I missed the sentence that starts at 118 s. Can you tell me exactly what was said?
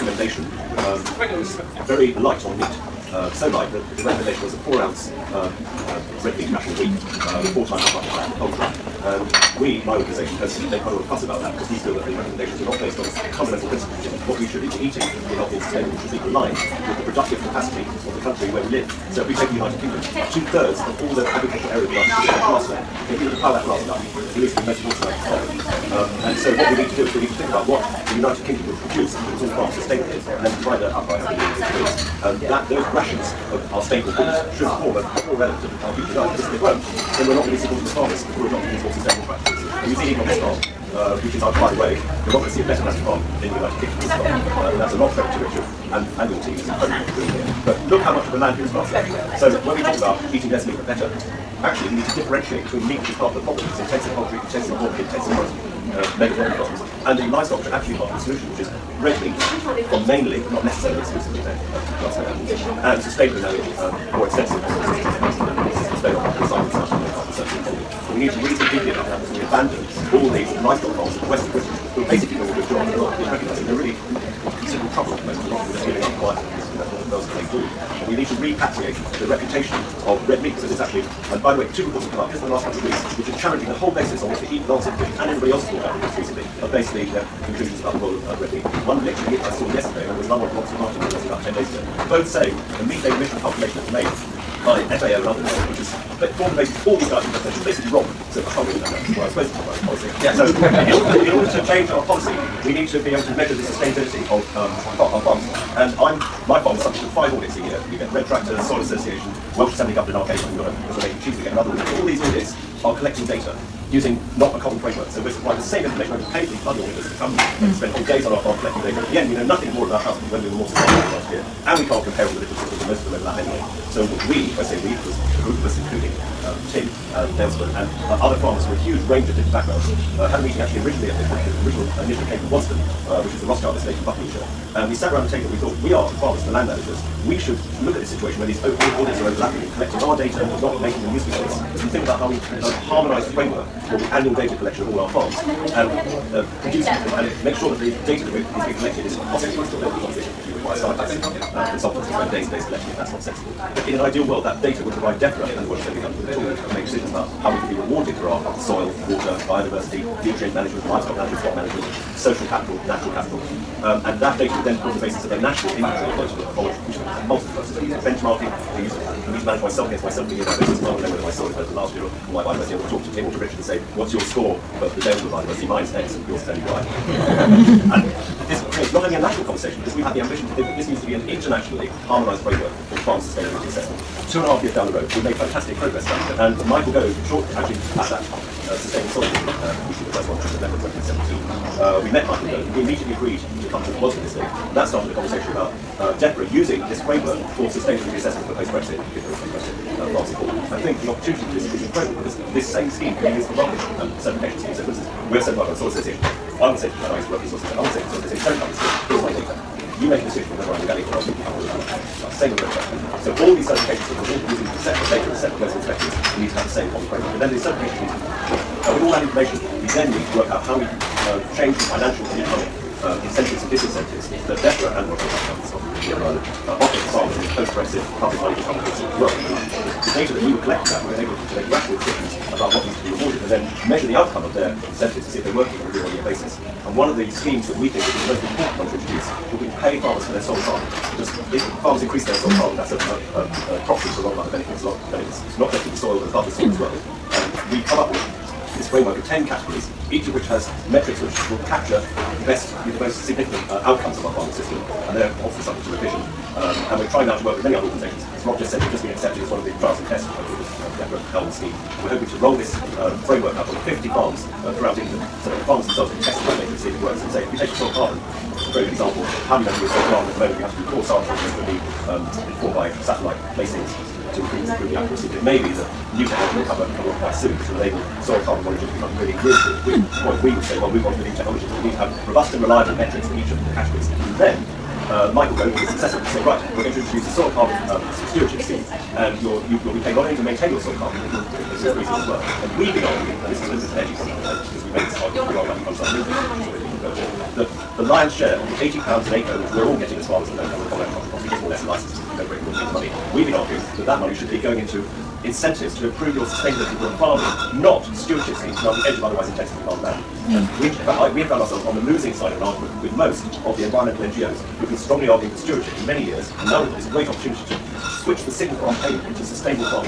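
At the end, we know nothing more about us when we were more sustainable last year.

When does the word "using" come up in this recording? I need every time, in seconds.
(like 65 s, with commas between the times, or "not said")
113 s, 196 s, 214 s.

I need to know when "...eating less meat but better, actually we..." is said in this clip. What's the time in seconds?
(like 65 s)
50 s.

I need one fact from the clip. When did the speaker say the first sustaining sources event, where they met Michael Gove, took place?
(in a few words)
November 2017.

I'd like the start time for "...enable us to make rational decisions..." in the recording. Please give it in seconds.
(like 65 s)
231 s.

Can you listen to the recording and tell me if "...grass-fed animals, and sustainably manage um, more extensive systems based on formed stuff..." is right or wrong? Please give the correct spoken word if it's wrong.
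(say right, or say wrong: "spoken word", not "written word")
wrong: "recycled", not "formed".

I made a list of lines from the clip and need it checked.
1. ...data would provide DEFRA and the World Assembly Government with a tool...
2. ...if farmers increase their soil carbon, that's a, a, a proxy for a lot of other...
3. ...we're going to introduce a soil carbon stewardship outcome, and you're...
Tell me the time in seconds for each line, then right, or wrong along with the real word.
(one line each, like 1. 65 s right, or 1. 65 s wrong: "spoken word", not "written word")
1. 154 s right
2. 241 s right
3. 286 s wrong: "scheme", not "outcome".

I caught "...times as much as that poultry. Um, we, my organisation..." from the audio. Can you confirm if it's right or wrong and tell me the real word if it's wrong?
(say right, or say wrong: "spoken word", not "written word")
right.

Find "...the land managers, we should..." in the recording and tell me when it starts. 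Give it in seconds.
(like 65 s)
136 s.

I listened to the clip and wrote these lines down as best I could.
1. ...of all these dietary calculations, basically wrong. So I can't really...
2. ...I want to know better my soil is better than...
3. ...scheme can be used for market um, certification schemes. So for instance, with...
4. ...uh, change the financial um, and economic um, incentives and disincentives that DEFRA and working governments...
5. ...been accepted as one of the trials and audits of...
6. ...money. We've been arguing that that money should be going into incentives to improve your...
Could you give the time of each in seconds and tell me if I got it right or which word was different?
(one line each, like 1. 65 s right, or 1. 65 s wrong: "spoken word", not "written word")
1. 96 s right
2. 170 s wrong: "whether", not "better"
3. 202 s right
4. 220 s right
5. 259 s wrong: "tests", not "audits"
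6. 302 s right.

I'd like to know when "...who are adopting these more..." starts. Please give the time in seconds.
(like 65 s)
38 s.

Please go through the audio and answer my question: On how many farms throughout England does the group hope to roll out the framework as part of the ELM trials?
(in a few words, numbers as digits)
50.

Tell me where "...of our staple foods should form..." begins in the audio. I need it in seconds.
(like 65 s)
33 s.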